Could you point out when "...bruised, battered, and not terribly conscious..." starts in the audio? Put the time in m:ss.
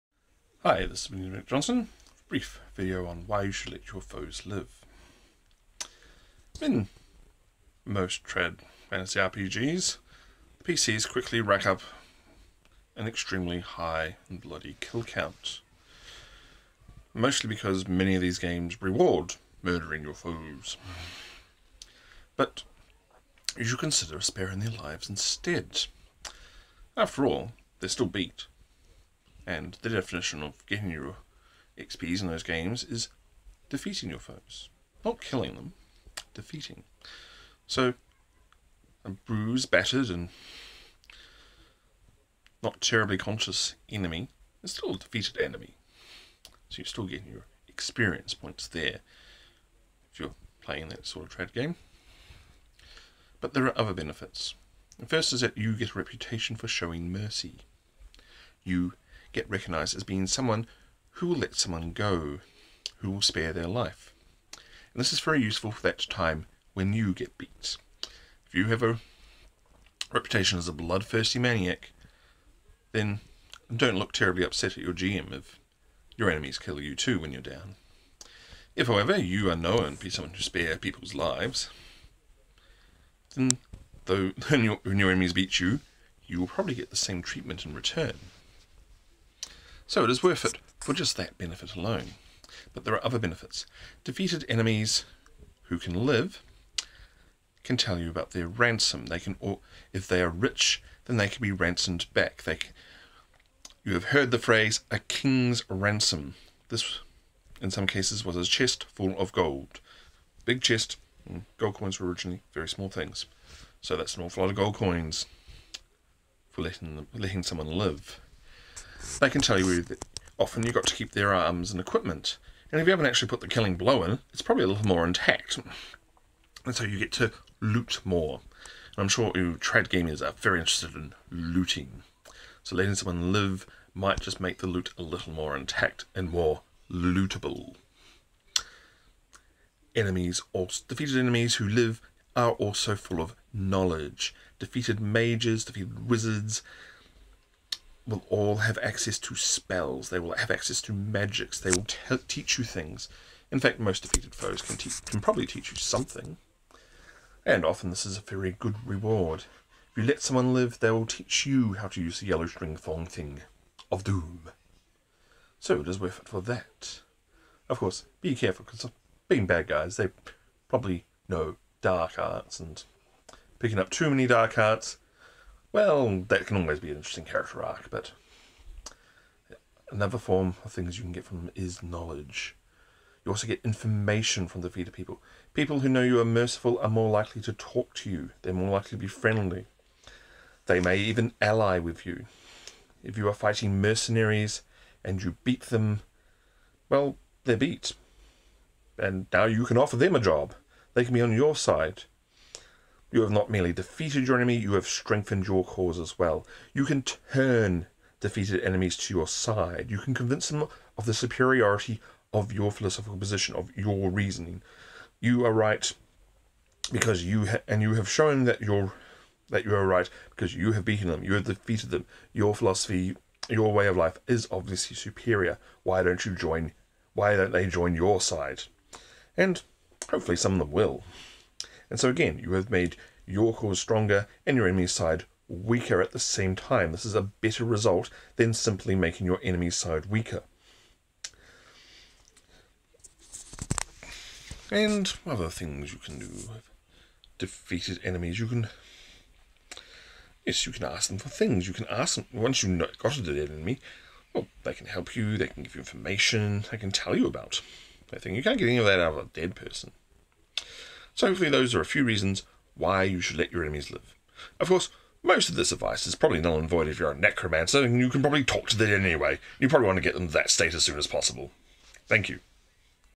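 0:39.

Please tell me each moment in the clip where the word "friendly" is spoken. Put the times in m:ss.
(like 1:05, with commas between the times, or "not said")
3:09.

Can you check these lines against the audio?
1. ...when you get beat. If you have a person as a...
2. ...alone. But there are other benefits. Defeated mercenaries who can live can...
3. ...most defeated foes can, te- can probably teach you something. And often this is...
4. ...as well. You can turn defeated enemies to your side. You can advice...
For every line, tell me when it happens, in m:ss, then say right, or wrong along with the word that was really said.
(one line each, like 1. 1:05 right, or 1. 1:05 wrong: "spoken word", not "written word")
1. 1:06 wrong: "reputation", not "person"
2. 1:31 wrong: "enemies", not "mercenaries"
3. 2:33 right
4. 3:25 wrong: "convince", not "advice".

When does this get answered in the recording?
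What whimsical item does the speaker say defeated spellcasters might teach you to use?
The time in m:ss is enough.
2:42.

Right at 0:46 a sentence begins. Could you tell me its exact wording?
So you're still getting your experience points there if you're playing that sort of trad game.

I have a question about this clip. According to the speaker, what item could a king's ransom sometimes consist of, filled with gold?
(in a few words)
a chest.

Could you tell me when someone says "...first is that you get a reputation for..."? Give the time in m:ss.
0:55.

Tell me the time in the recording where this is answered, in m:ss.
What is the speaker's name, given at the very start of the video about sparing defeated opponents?
0:01.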